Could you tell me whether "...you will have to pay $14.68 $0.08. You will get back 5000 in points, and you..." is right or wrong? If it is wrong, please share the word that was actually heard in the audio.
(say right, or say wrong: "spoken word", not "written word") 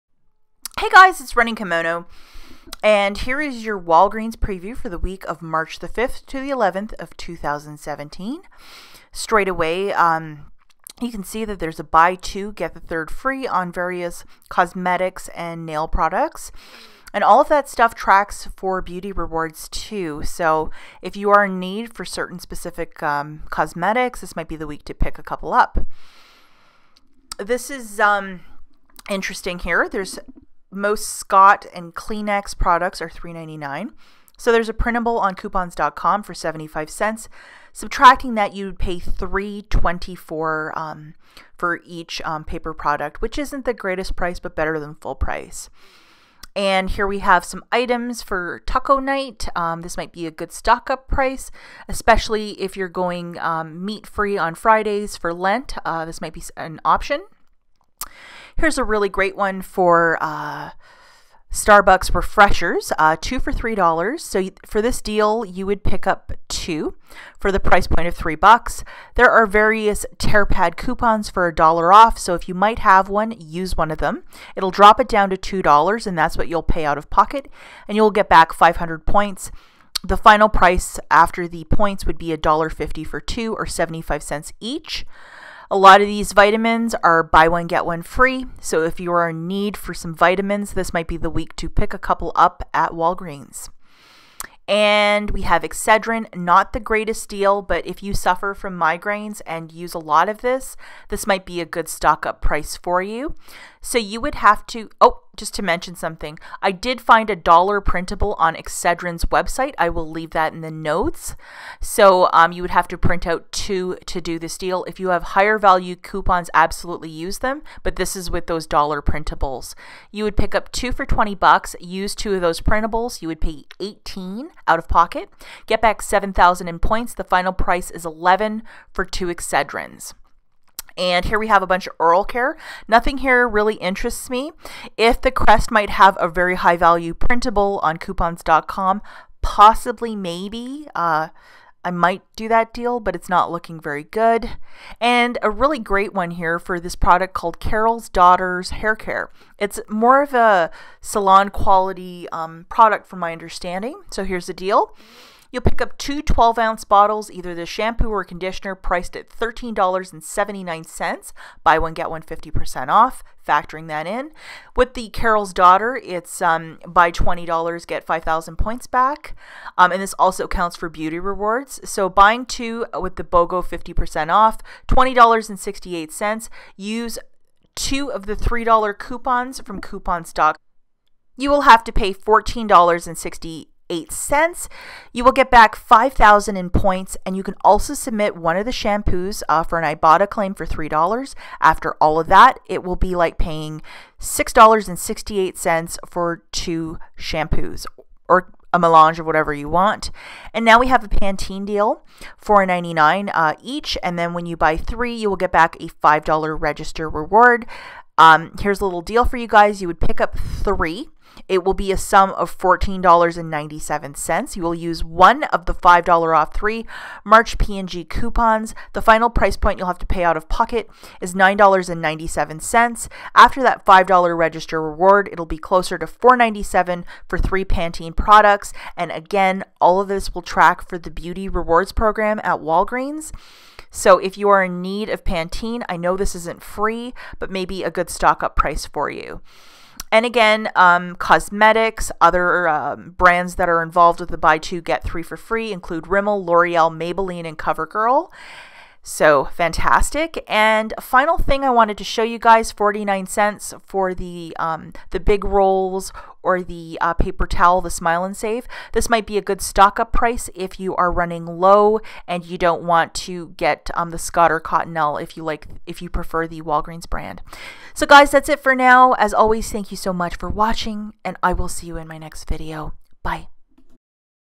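right.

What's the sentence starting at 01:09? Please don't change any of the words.
There are various pad coupons for a dollar off.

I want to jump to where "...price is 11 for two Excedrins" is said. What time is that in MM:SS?
02:07.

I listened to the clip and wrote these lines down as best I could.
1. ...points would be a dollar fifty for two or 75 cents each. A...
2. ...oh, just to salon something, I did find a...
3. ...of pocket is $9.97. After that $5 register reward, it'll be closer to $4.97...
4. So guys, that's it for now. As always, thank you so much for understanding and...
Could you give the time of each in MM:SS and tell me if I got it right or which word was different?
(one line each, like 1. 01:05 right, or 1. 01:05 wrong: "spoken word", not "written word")
1. 01:21 right
2. 01:44 wrong: "mention", not "salon"
3. 03:40 right
4. 04:27 wrong: "watching", not "understanding".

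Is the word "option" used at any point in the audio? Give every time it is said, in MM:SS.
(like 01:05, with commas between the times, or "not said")
00:56.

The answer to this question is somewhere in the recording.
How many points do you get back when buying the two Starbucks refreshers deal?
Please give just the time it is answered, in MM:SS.
01:18.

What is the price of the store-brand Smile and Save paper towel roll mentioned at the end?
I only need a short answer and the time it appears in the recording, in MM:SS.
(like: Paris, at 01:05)
49 cents, at 04:12.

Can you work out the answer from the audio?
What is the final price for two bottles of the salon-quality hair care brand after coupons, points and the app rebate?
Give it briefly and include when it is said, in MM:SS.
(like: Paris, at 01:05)
$6.68, at 03:14.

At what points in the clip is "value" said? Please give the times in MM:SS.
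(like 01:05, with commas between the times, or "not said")
01:55, 02:16.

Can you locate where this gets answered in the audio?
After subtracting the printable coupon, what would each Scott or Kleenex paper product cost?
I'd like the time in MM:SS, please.
00:38.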